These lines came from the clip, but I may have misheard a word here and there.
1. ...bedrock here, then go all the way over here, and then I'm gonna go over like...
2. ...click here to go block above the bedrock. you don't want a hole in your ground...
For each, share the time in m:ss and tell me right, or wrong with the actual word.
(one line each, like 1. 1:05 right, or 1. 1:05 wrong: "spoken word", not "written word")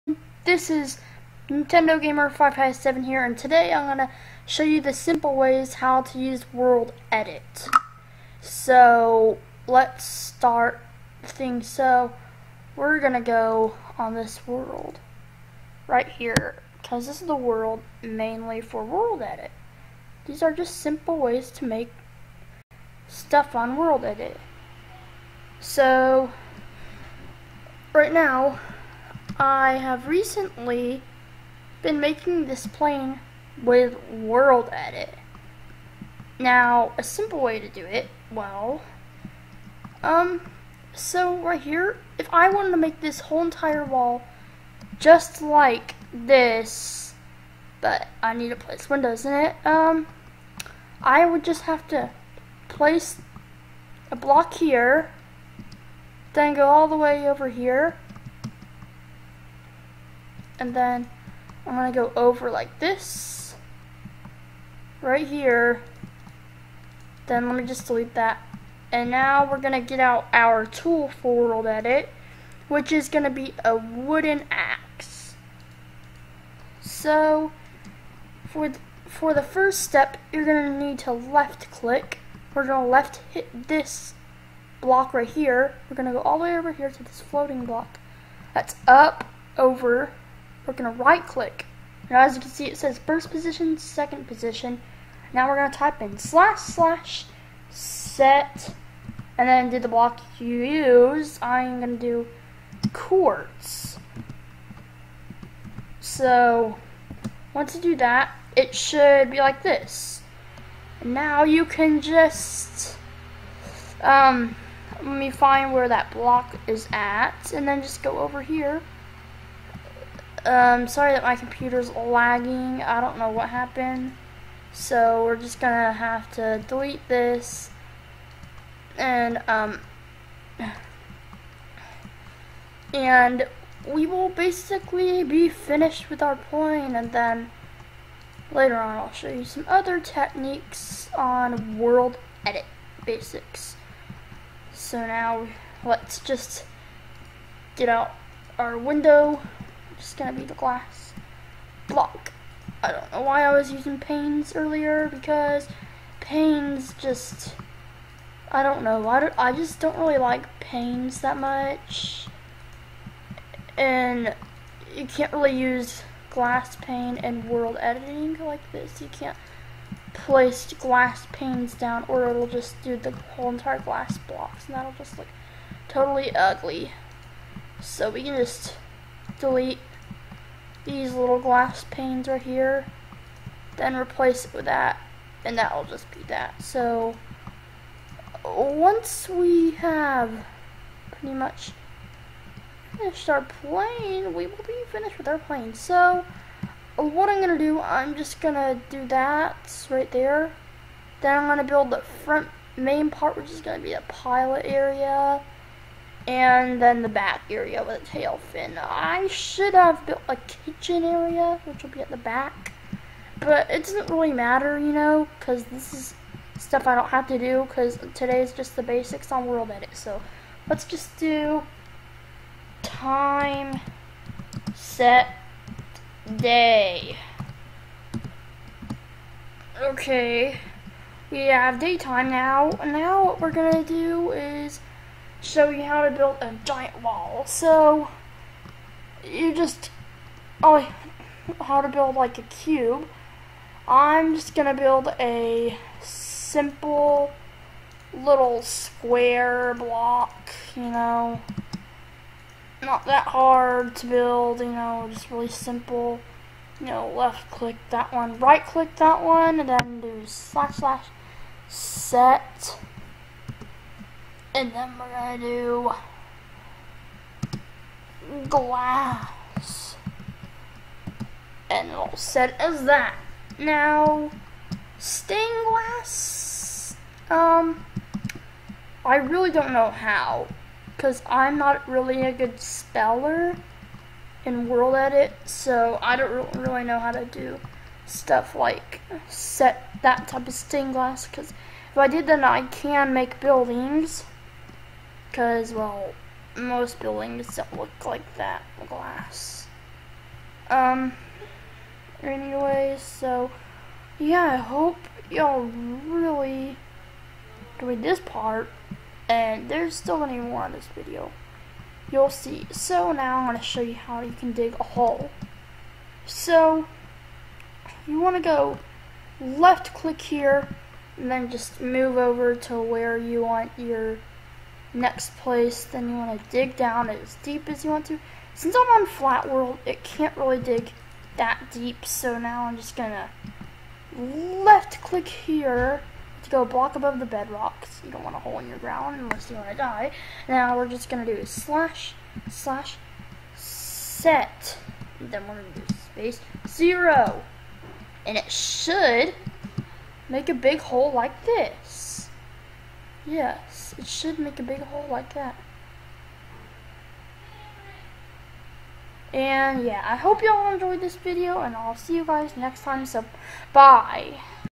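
1. 0:54 wrong: "block", not "bedrock"
2. 5:35 right.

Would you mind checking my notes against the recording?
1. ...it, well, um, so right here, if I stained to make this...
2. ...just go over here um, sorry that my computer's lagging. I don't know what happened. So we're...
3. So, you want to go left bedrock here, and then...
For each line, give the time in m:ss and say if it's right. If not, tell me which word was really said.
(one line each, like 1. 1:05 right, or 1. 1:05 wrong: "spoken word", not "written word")
1. 0:37 wrong: "wanted", not "stained"
2. 1:57 right
3. 5:16 wrong: "click", not "bedrock".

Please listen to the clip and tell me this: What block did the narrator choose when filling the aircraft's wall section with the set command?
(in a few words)
Quartz.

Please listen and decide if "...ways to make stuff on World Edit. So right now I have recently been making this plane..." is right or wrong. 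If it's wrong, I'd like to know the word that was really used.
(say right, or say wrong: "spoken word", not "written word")
right.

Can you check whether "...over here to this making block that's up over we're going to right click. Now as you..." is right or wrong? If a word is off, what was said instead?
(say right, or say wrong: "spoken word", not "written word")
wrong: "floating", not "making".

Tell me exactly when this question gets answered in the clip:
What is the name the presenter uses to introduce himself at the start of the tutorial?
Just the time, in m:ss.
0:01.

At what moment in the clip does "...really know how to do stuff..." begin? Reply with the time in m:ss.
4:46.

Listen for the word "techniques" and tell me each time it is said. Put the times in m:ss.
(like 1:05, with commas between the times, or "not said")
2:19.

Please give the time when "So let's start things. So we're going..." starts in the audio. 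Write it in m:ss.
0:08.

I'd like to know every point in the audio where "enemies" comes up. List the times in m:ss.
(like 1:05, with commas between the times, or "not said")
not said.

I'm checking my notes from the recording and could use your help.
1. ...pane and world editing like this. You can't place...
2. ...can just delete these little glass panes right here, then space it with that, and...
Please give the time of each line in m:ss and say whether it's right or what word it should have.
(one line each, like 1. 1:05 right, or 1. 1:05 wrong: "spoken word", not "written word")
1. 2:46 right
2. 2:58 wrong: "replace", not "space".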